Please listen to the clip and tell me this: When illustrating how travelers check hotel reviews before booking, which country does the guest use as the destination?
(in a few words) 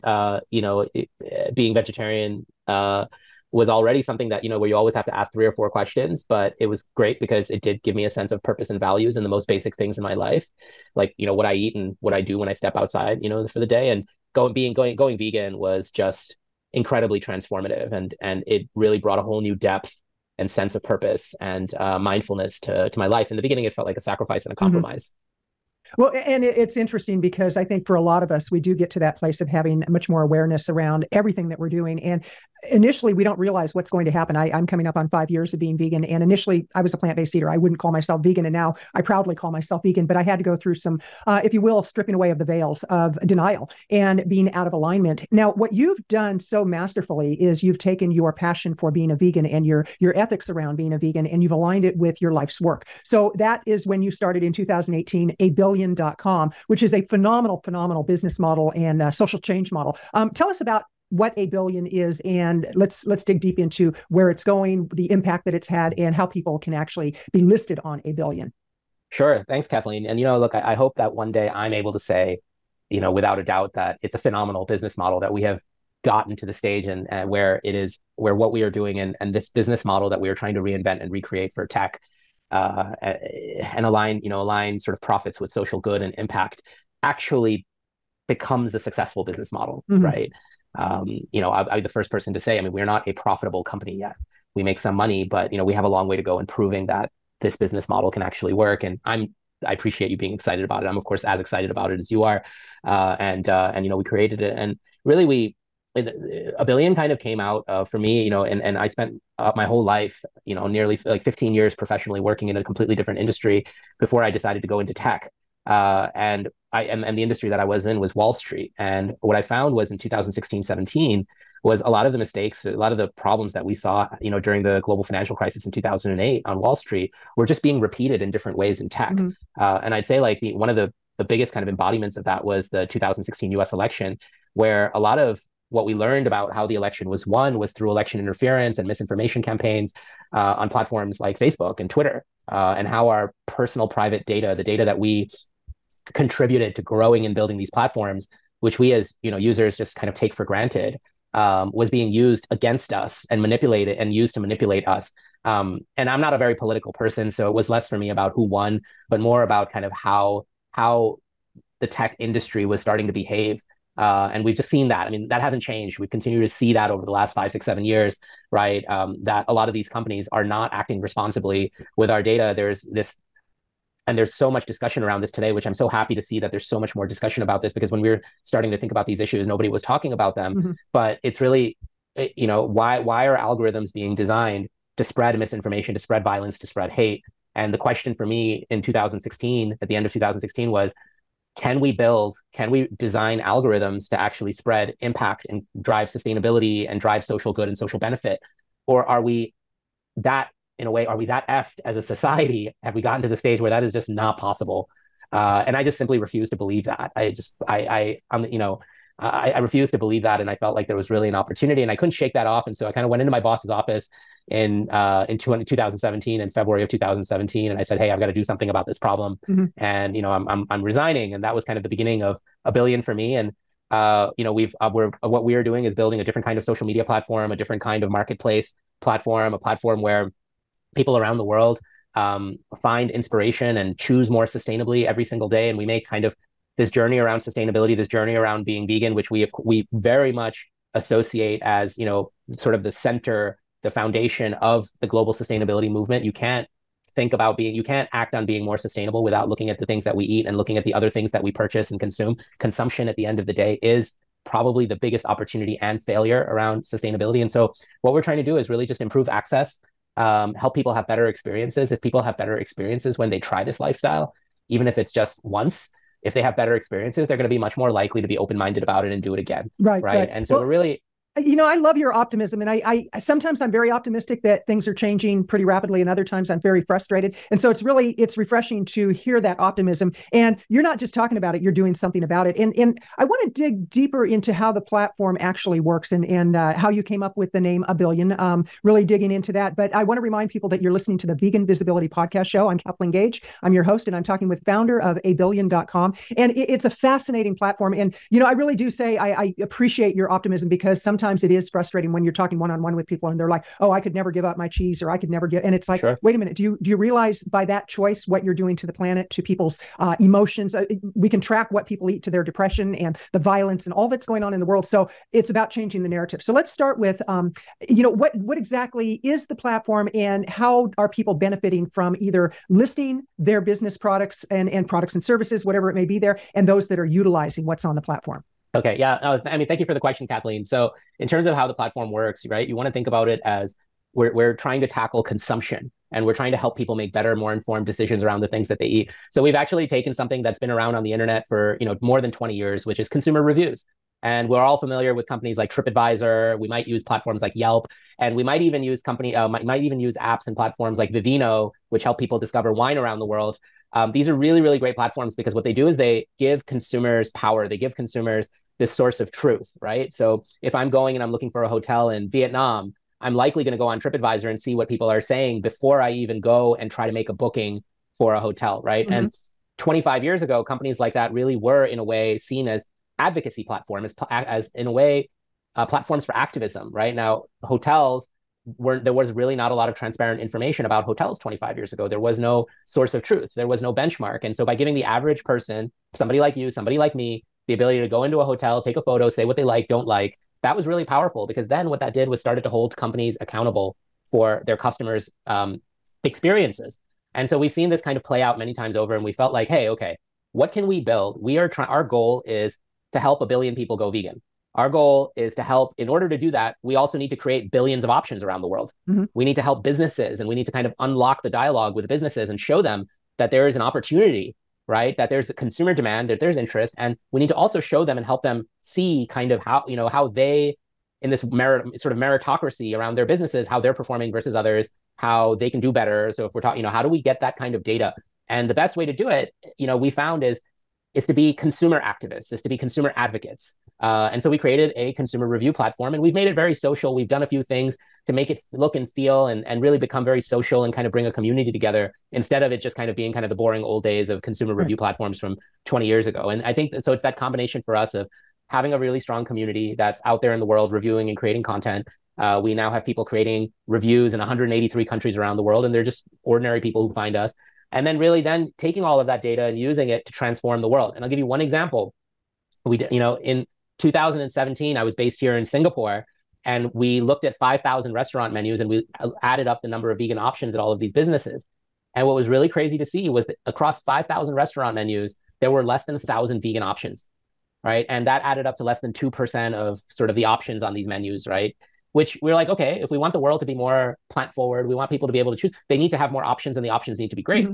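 Vietnam.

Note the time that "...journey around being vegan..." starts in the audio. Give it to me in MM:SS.
03:58.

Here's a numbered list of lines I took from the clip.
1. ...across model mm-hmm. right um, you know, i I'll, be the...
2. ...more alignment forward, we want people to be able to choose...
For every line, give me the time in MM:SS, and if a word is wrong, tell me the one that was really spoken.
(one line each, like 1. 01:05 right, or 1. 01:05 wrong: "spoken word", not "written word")
1. 01:29 wrong: "business", not "across"
2. 08:03 wrong: "plant", not "alignment".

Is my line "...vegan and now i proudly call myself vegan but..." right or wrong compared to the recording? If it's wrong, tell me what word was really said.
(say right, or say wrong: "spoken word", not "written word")
right.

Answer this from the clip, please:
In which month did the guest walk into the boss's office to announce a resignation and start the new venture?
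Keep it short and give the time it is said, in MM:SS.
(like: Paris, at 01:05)
February, at 03:36.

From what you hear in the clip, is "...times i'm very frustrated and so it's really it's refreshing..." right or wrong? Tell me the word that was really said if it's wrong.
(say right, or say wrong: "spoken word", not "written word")
right.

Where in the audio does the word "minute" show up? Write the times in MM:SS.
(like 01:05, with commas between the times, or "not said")
05:06.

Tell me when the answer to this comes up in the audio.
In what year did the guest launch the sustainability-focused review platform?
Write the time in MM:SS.
00:54.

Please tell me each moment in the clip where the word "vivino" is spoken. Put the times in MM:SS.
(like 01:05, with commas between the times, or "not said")
05:51.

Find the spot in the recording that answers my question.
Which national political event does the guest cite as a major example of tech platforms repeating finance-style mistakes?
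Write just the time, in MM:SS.
02:12.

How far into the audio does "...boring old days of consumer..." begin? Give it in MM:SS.
07:23.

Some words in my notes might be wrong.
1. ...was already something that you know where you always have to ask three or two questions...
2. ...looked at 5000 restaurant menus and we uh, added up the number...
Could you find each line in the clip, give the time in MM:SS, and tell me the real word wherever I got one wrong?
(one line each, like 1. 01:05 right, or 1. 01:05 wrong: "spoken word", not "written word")
1. 00:03 wrong: "four", not "two"
2. 07:47 right.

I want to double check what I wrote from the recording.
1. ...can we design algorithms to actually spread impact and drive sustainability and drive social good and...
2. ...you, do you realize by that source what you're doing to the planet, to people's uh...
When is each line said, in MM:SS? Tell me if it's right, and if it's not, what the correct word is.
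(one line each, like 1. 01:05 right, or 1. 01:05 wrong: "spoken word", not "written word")
1. 03:12 right
2. 05:06 wrong: "choice", not "source".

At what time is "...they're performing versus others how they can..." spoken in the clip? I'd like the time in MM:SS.
07:03.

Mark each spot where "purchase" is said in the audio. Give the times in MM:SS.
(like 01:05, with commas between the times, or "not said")
04:11.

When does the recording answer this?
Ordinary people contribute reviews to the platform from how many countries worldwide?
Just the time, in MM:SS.
07:34.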